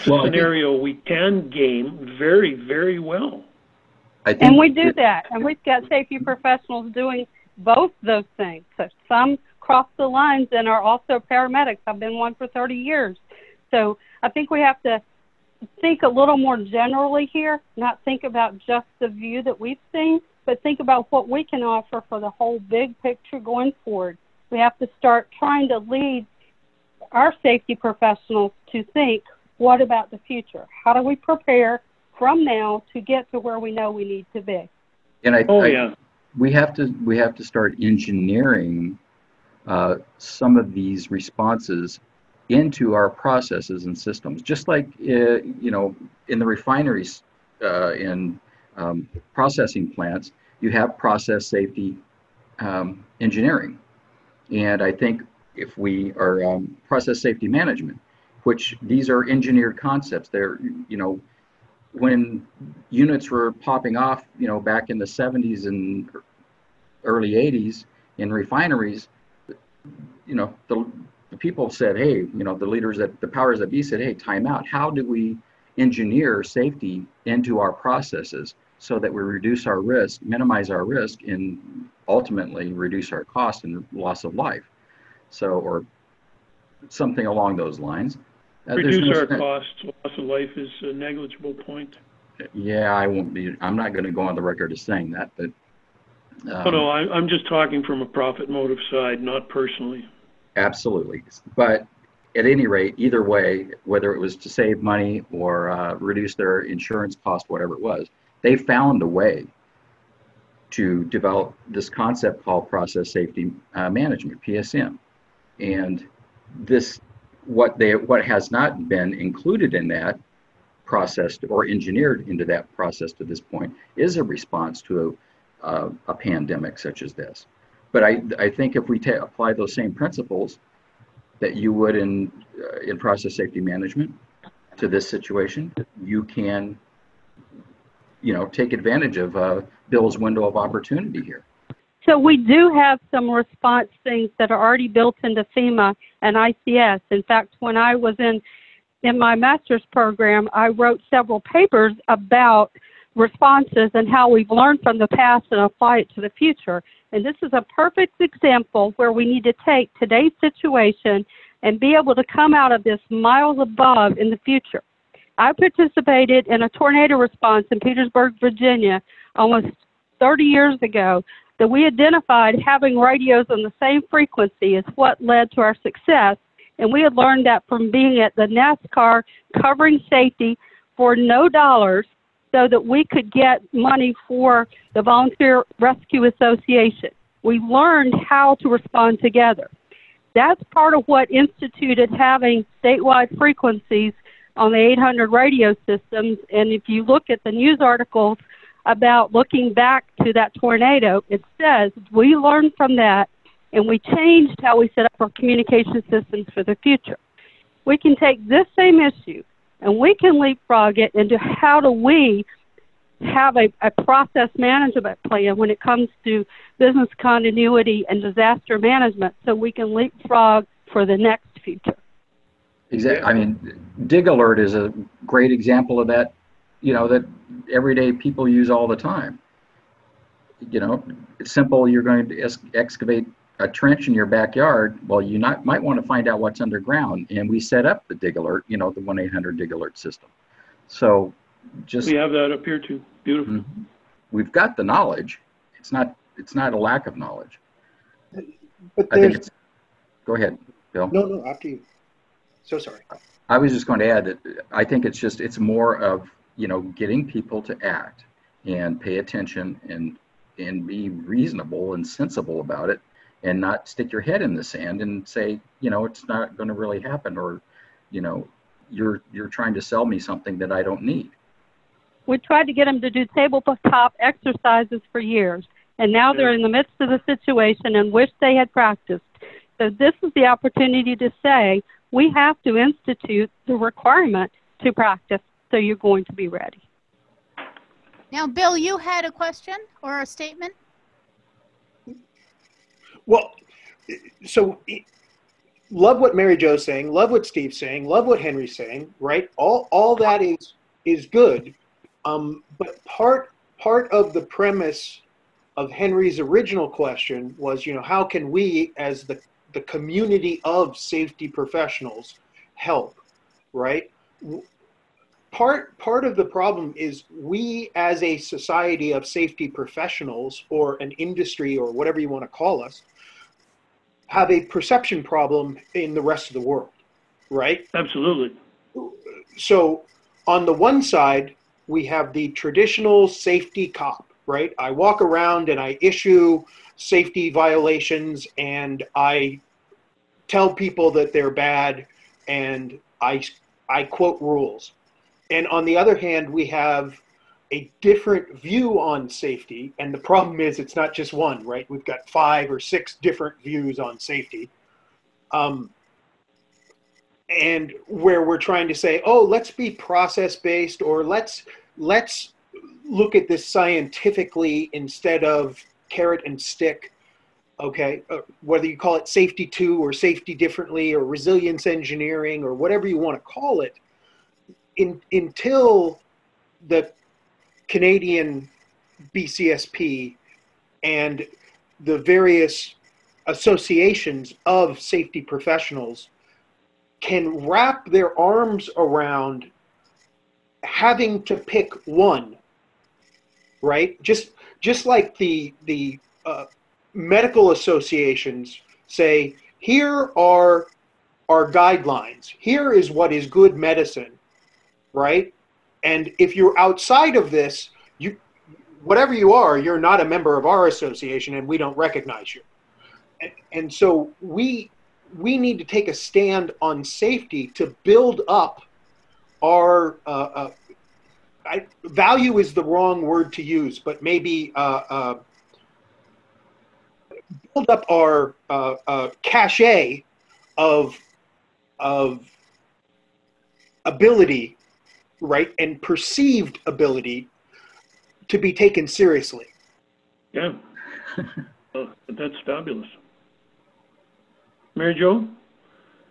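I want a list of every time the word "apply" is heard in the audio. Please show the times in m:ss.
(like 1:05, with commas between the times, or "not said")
2:09, 2:35.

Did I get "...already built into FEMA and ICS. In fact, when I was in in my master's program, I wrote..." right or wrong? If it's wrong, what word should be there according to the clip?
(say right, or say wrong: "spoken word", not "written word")
right.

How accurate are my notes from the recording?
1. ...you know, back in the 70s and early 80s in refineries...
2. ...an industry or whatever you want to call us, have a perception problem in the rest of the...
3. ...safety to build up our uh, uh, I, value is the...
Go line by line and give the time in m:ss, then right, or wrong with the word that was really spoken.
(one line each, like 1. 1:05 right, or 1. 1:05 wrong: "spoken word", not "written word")
1. 1:04 right
2. 5:20 right
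3. 6:57 right.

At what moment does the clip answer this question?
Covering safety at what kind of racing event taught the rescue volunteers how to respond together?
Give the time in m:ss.
2:58.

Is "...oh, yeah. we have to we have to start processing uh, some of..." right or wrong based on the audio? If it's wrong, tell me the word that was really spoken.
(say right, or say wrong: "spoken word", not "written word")
wrong: "engineering", not "processing".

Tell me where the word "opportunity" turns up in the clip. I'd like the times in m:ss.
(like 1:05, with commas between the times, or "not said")
2:20, 4:40.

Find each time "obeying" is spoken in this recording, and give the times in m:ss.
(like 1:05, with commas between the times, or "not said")
not said.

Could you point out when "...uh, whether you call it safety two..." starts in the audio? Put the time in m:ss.
6:08.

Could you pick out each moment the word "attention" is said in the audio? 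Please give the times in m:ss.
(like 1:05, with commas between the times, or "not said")
4:19.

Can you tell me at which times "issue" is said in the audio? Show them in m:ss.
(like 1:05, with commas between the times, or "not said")
3:28, 5:35.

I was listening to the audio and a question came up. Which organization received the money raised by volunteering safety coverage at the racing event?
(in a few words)
Volunteer Rescue Association.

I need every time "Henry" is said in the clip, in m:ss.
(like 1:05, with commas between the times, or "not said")
4:58, 5:05.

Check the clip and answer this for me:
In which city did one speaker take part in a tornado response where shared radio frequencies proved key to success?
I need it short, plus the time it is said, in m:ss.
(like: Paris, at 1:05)
Petersburg, Virginia, at 2:47.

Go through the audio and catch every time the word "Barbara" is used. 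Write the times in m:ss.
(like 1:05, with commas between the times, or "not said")
not said.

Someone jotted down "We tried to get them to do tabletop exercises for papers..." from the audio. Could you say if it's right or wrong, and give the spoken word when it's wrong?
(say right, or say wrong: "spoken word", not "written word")
wrong: "years", not "papers".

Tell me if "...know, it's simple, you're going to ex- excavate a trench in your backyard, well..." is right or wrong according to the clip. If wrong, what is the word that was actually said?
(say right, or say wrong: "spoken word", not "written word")
right.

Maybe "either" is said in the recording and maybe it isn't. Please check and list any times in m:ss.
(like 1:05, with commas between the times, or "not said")
1:42.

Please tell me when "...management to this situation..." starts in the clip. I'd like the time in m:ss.
2:13.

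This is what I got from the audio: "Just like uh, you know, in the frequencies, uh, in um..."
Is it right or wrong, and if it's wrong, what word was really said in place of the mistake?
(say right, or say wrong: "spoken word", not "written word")
wrong: "refineries", not "frequencies".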